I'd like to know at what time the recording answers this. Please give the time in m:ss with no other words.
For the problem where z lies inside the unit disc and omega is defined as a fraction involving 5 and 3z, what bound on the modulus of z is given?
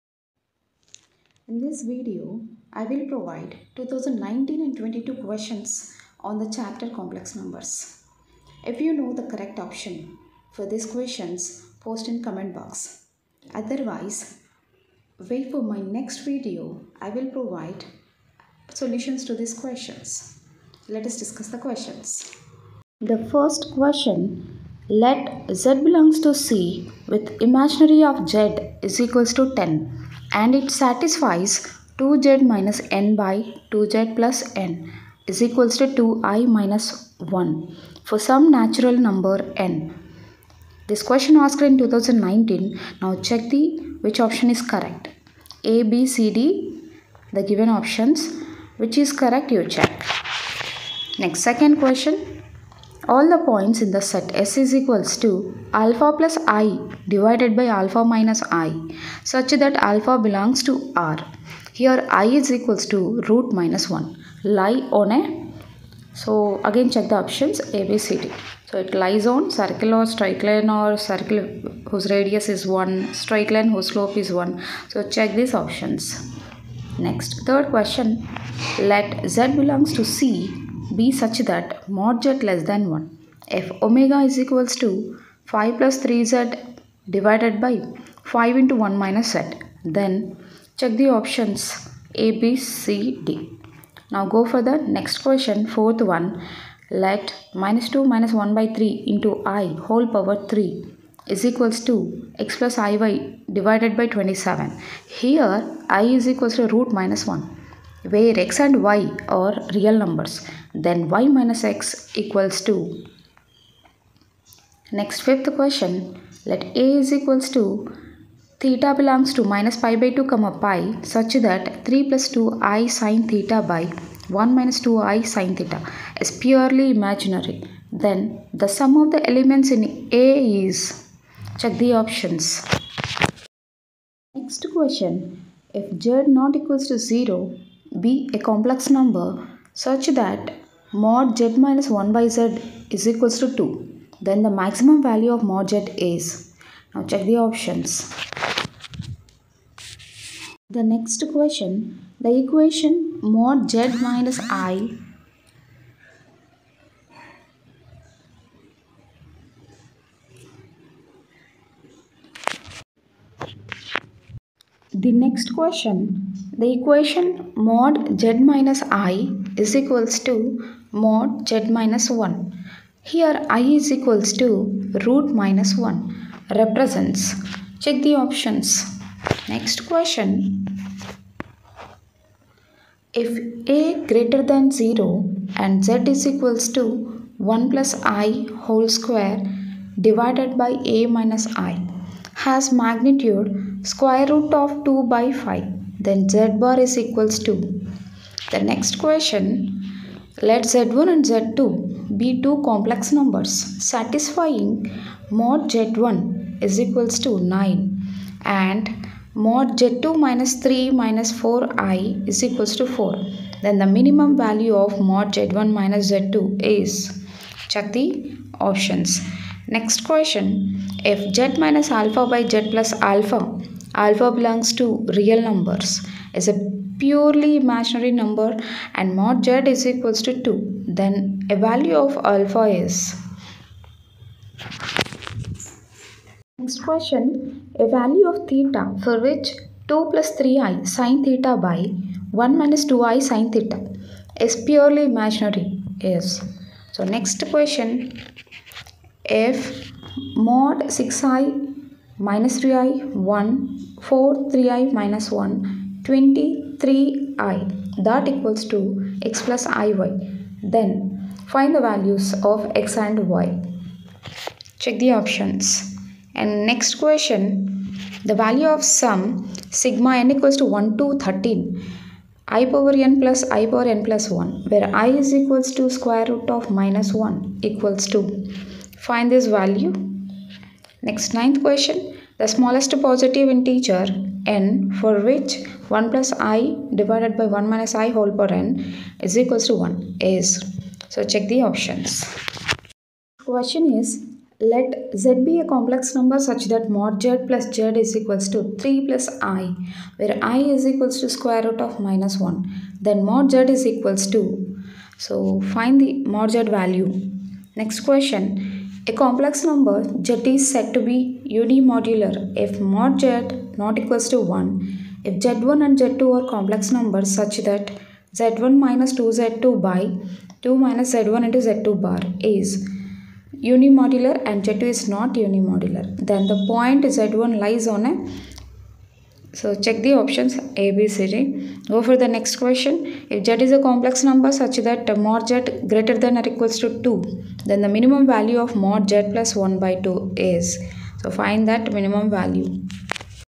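1:21.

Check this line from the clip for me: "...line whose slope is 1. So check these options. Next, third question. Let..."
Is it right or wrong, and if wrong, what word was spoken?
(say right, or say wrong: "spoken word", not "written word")
right.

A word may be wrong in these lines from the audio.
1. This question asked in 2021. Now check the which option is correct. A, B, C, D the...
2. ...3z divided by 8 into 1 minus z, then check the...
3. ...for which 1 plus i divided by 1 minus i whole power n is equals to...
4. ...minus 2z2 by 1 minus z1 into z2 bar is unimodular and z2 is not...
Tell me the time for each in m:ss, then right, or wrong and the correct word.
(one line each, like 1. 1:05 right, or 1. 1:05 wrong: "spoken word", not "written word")
1. 0:40 wrong: "2019", not "2021"
2. 1:26 wrong: "5", not "8"
3. 4:44 right
4. 5:18 wrong: "2", not "1".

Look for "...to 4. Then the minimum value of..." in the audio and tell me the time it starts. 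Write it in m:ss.
3:32.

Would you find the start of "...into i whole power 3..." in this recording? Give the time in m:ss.
1:39.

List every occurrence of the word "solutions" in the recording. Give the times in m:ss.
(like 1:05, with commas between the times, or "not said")
0:18.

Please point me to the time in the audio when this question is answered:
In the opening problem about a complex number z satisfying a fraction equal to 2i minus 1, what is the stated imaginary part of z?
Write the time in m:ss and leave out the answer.
0:27.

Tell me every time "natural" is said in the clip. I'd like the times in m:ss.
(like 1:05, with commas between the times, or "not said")
0:38.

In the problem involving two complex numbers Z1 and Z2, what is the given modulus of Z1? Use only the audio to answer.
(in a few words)
9.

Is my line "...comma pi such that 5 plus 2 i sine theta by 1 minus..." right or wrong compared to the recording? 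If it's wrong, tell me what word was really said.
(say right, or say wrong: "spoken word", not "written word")
wrong: "3", not "5".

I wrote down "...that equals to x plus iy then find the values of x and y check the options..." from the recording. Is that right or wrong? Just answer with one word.
right.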